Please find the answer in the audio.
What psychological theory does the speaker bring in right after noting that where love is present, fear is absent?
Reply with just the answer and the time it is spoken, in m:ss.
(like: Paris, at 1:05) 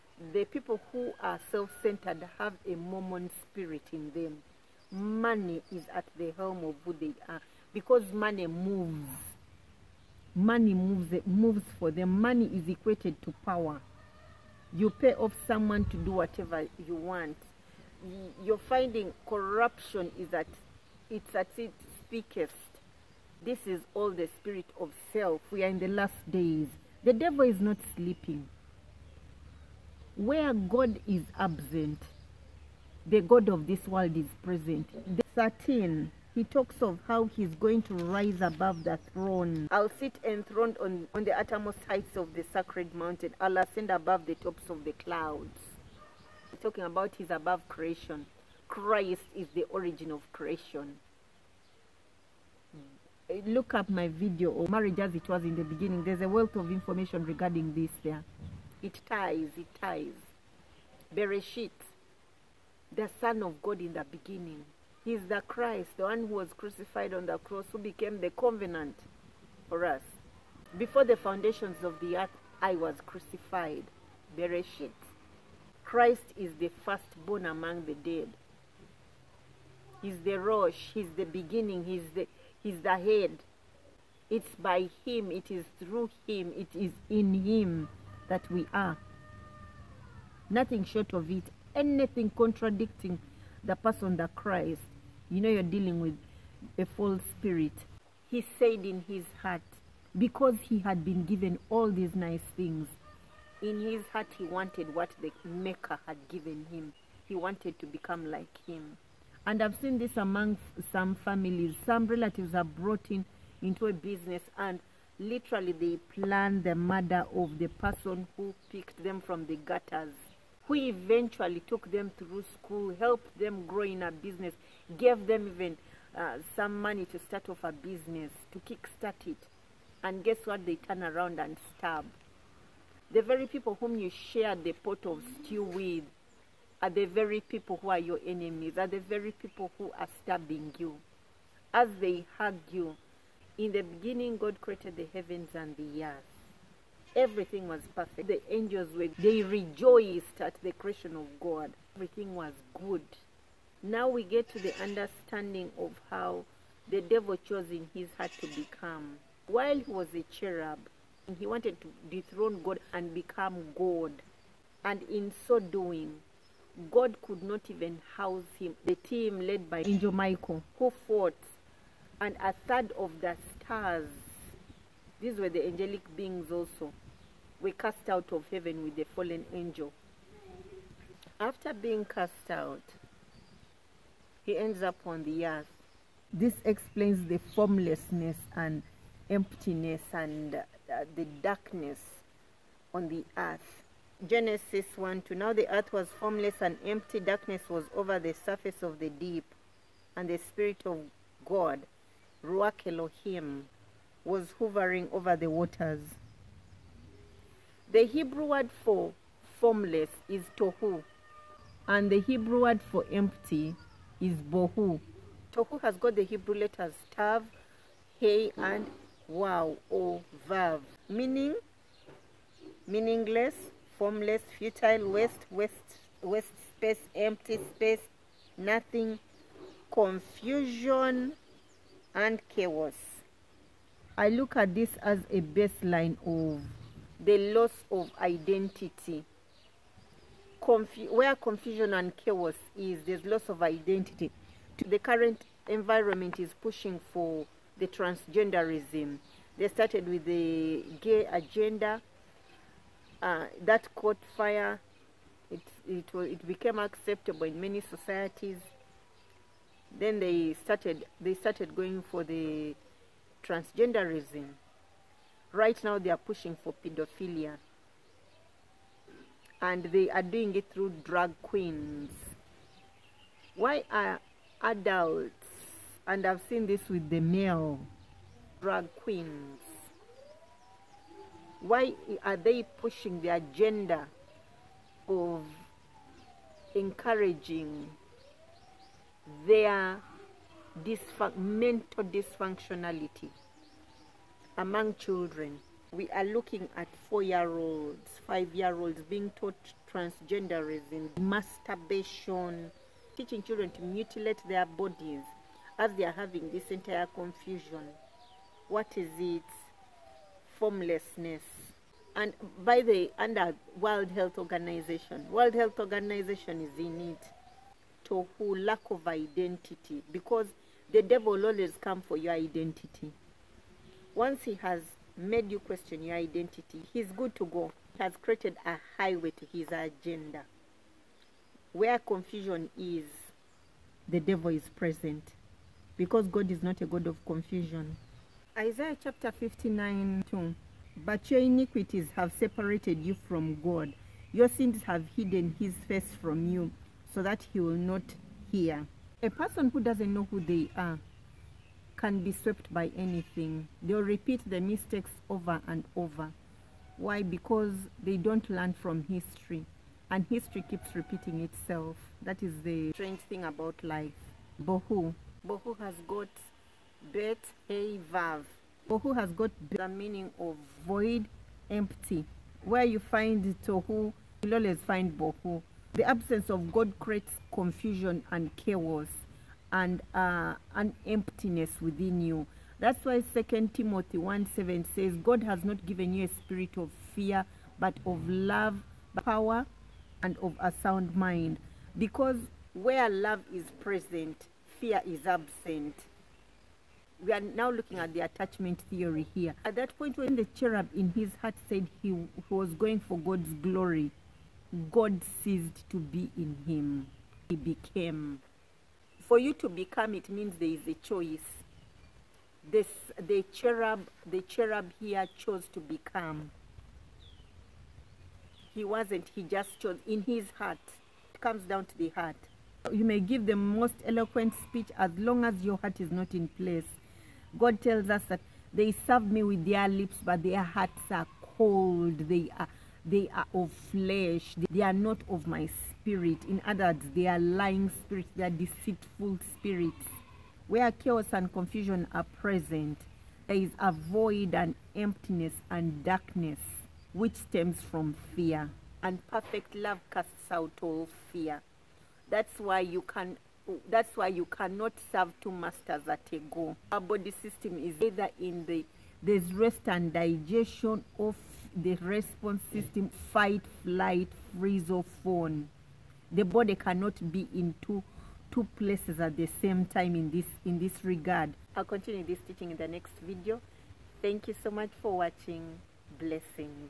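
attachment theory, at 6:38.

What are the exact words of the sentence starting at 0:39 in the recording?
I'll sit enthroned on, on the uttermost heights of the sacred mountain.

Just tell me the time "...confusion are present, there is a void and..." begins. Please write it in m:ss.
7:21.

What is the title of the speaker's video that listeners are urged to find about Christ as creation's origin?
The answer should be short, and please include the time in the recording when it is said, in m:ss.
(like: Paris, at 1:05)
marriage as it was in the beginning, at 0:54.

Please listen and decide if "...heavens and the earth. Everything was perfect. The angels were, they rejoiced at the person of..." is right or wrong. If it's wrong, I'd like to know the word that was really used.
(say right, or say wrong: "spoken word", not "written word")
wrong: "creation", not "person".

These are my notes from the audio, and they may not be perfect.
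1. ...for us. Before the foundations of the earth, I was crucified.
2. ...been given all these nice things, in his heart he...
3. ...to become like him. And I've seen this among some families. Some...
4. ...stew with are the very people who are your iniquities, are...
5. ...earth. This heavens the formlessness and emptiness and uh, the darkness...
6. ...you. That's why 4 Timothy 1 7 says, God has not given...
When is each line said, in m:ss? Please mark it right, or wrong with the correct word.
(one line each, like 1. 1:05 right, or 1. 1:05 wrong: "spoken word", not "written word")
1. 1:09 right
2. 1:41 right
3. 1:47 right
4. 2:15 wrong: "enemies", not "iniquities"
5. 3:05 wrong: "explains", not "heavens"
6. 6:22 wrong: "2", not "4".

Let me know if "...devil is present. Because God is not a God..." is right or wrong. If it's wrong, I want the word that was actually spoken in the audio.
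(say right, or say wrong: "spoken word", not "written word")
right.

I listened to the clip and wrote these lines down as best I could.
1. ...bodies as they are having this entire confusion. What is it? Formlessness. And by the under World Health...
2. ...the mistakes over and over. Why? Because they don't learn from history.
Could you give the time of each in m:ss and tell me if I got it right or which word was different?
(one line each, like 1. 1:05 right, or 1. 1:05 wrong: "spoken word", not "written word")
1. 5:04 right
2. 5:54 right.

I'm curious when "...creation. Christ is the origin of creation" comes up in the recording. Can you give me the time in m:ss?
0:47.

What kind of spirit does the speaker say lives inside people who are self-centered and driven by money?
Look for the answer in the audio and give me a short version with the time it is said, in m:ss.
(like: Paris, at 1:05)
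mammon spirit, at 0:02.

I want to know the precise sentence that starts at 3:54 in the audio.
I look at this as a baseline of the loss of identity.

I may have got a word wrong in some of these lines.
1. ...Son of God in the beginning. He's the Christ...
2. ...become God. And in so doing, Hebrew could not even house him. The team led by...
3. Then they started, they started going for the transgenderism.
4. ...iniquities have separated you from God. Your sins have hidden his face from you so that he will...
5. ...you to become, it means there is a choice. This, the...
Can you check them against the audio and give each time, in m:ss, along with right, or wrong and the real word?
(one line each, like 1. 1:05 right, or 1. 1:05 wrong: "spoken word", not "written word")
1. 1:03 right
2. 2:43 wrong: "God", not "Hebrew"
3. 4:19 right
4. 5:41 right
5. 6:49 right.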